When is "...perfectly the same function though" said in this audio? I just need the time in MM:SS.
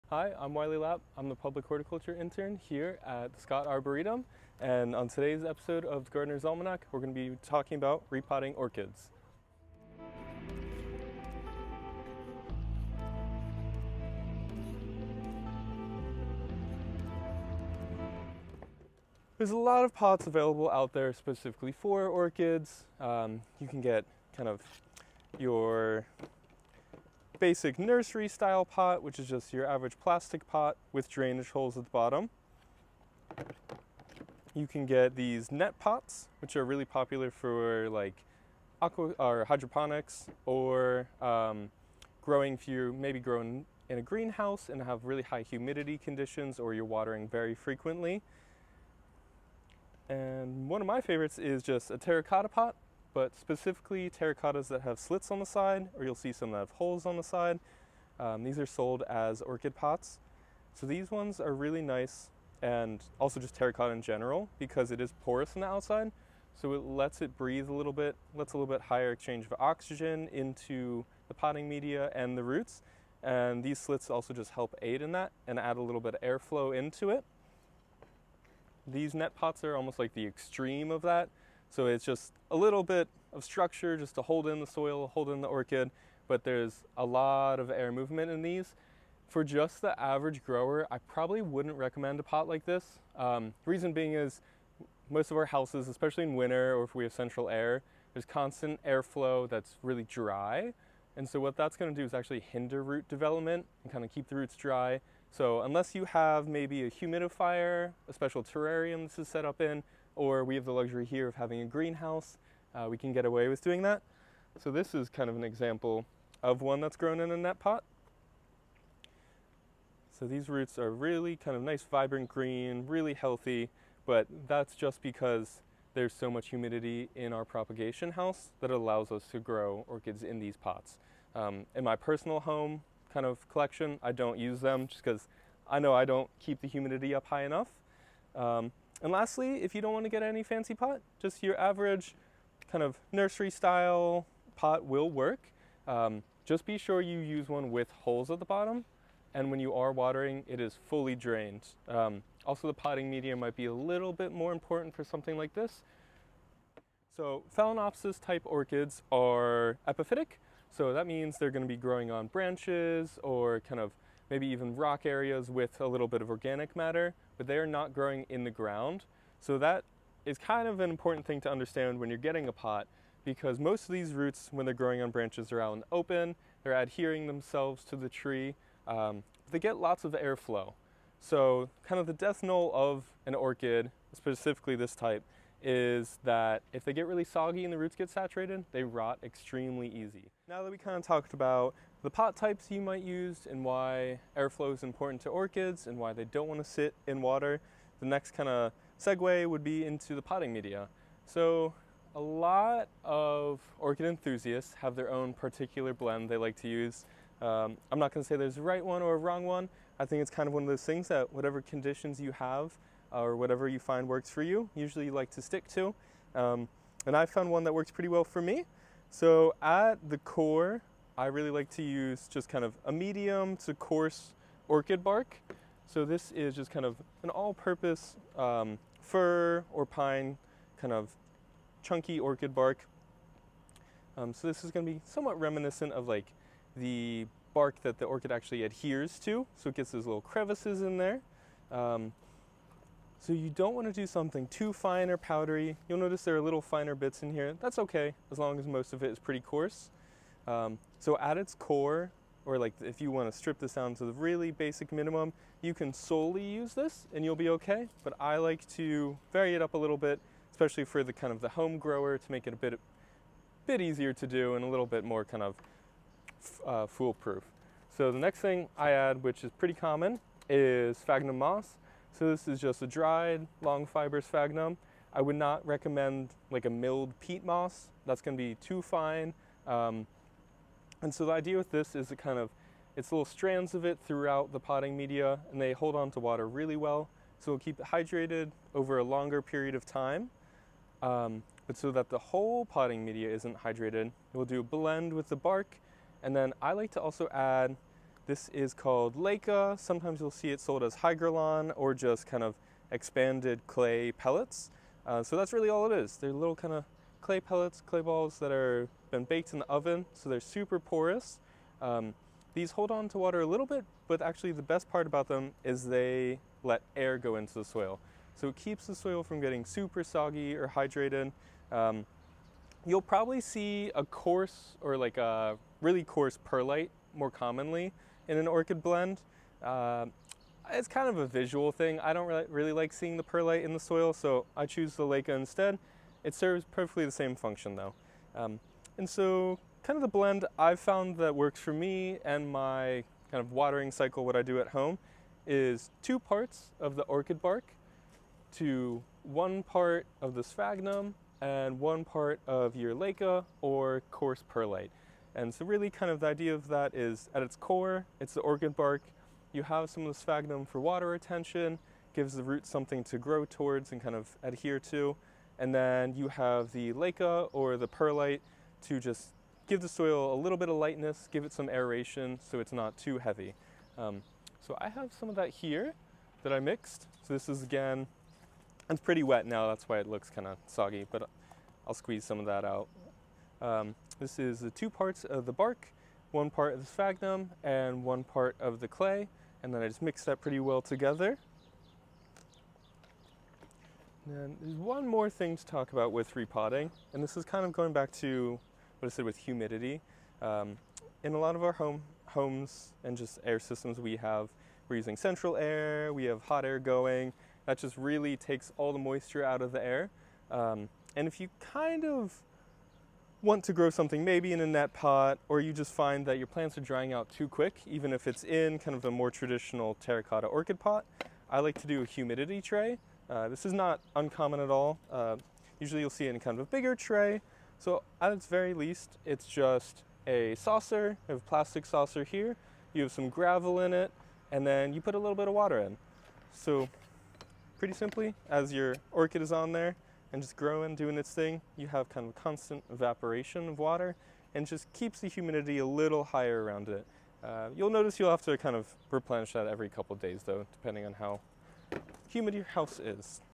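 05:36.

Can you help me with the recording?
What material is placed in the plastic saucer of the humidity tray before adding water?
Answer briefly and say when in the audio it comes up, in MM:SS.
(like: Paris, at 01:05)
Gravel, at 07:13.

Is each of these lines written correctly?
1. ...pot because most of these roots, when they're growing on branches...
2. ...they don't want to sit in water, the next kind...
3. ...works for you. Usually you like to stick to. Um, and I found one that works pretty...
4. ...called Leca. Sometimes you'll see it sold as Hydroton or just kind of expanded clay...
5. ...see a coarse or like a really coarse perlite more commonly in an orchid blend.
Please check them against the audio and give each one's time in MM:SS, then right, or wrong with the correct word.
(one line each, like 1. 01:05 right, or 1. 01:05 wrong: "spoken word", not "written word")
1. 02:52 right
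2. 03:16 right
3. 03:34 right
4. 04:58 right
5. 05:23 right.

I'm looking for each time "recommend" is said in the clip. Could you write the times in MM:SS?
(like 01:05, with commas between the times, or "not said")
01:31, 04:35.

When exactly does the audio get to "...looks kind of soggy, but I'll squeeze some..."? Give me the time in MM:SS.
06:20.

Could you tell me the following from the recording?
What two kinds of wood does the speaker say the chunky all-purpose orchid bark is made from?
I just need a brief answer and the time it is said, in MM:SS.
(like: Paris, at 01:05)
Fir or pine, at 03:49.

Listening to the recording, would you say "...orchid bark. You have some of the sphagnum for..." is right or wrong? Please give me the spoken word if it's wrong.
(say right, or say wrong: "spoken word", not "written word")
right.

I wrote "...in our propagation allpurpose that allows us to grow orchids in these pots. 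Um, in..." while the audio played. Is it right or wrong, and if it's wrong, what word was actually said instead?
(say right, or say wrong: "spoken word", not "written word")
wrong: "house", not "allpurpose".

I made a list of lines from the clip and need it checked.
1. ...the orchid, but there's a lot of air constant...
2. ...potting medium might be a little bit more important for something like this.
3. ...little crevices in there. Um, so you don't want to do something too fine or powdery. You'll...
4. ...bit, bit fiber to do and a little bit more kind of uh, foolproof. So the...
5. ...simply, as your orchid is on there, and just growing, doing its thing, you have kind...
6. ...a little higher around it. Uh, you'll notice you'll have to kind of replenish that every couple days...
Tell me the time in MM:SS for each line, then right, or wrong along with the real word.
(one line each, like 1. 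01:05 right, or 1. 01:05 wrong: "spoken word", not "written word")
1. 01:25 wrong: "movement", not "constant"
2. 02:32 right
3. 04:00 right
4. 04:22 wrong: "easier", not "fiber"
5. 07:17 right
6. 07:25 right.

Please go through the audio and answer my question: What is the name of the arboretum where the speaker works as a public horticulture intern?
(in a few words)
Scott Arboretum.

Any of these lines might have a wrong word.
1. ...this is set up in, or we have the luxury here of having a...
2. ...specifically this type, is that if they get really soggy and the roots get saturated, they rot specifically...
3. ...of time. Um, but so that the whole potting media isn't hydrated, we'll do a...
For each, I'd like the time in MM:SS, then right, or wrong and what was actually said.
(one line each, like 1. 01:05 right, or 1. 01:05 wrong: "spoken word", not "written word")
1. 01:49 right
2. 03:04 wrong: "extremely", not "specifically"
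3. 04:49 right.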